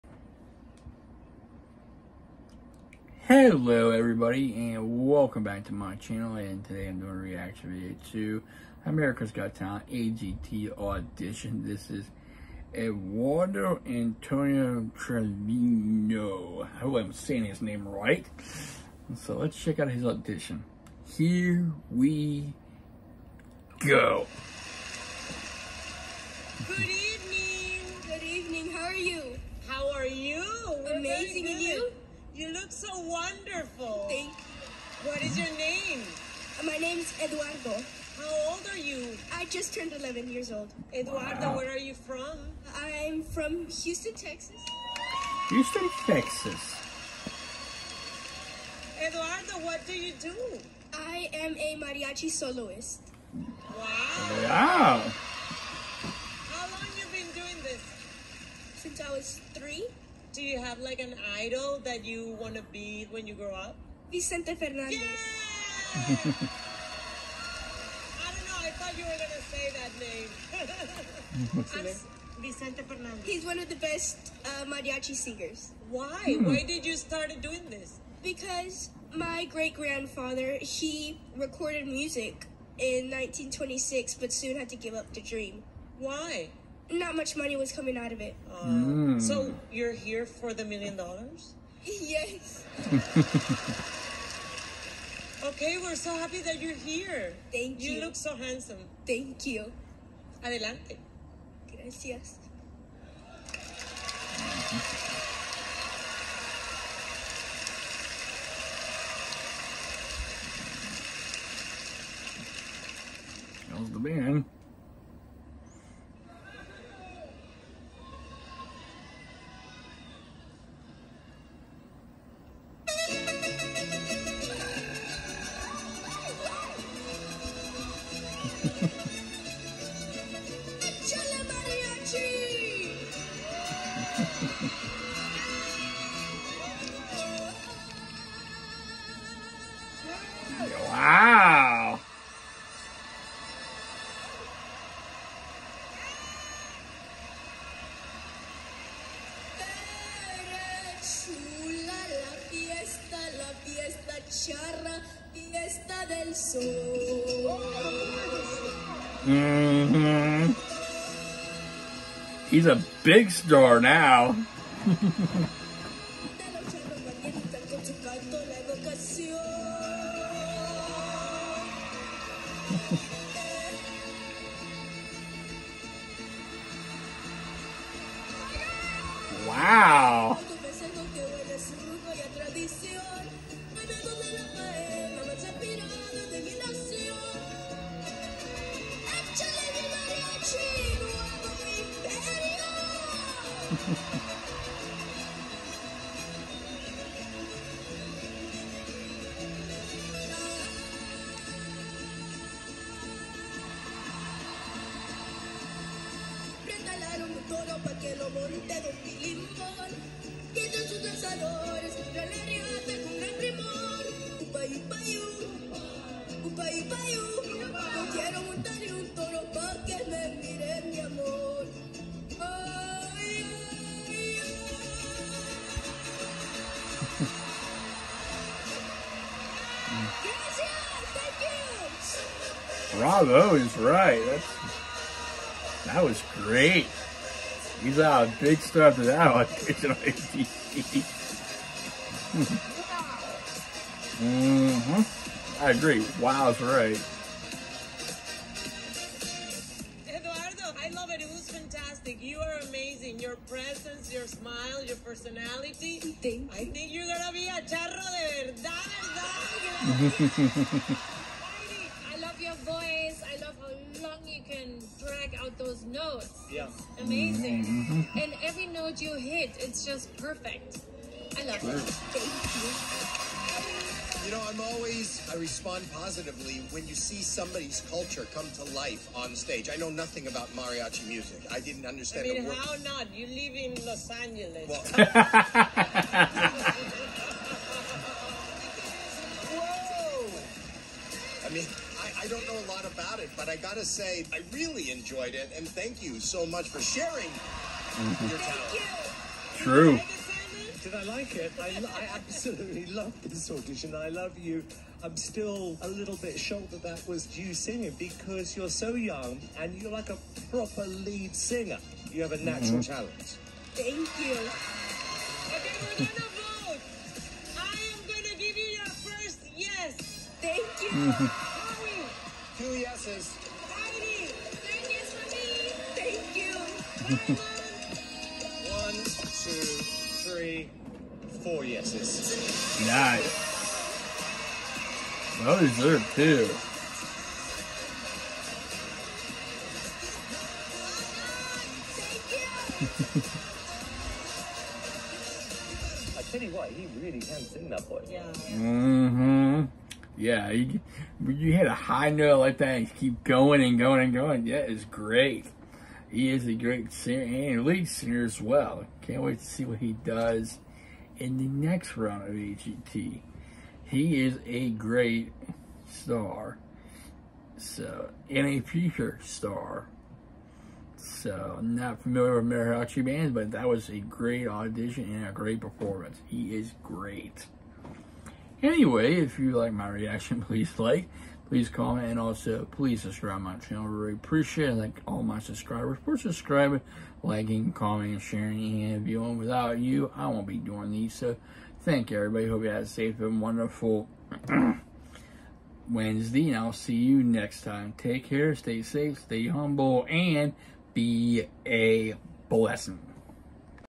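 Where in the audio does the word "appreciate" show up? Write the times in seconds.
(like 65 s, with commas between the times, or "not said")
384 s.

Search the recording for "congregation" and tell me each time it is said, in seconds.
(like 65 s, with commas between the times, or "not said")
not said.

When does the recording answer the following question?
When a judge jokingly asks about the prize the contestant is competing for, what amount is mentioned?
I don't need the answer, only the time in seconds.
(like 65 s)
90 s.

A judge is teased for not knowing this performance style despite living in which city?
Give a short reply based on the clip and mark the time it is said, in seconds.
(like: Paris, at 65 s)
Los Angeles, at 283 s.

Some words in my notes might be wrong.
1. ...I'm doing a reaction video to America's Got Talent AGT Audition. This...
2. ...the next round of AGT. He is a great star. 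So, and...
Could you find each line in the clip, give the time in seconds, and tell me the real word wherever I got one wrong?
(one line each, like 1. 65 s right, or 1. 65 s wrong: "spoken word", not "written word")
1. 6 s right
2. 361 s right.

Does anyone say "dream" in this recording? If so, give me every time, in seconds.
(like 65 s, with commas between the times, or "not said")
85 s.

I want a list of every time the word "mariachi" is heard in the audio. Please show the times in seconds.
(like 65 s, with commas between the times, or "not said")
51 s, 74 s, 280 s, 372 s.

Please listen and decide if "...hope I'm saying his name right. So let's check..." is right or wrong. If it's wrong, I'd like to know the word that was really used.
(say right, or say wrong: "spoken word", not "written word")
right.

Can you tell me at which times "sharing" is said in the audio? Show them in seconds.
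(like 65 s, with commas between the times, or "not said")
296 s, 388 s.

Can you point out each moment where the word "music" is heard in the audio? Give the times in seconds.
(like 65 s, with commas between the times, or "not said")
81 s, 281 s.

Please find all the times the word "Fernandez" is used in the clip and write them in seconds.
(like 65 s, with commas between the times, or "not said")
64 s, 72 s.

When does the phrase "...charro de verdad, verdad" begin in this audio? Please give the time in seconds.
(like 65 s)
257 s.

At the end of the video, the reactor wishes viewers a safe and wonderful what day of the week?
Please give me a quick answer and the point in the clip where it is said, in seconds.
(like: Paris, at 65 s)
Wednesday, at 395 s.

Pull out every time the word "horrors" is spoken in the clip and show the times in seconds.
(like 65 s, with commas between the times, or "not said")
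not said.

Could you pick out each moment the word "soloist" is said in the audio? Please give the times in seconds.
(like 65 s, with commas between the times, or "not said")
52 s.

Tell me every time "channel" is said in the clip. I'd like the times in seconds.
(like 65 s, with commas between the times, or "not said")
5 s, 383 s.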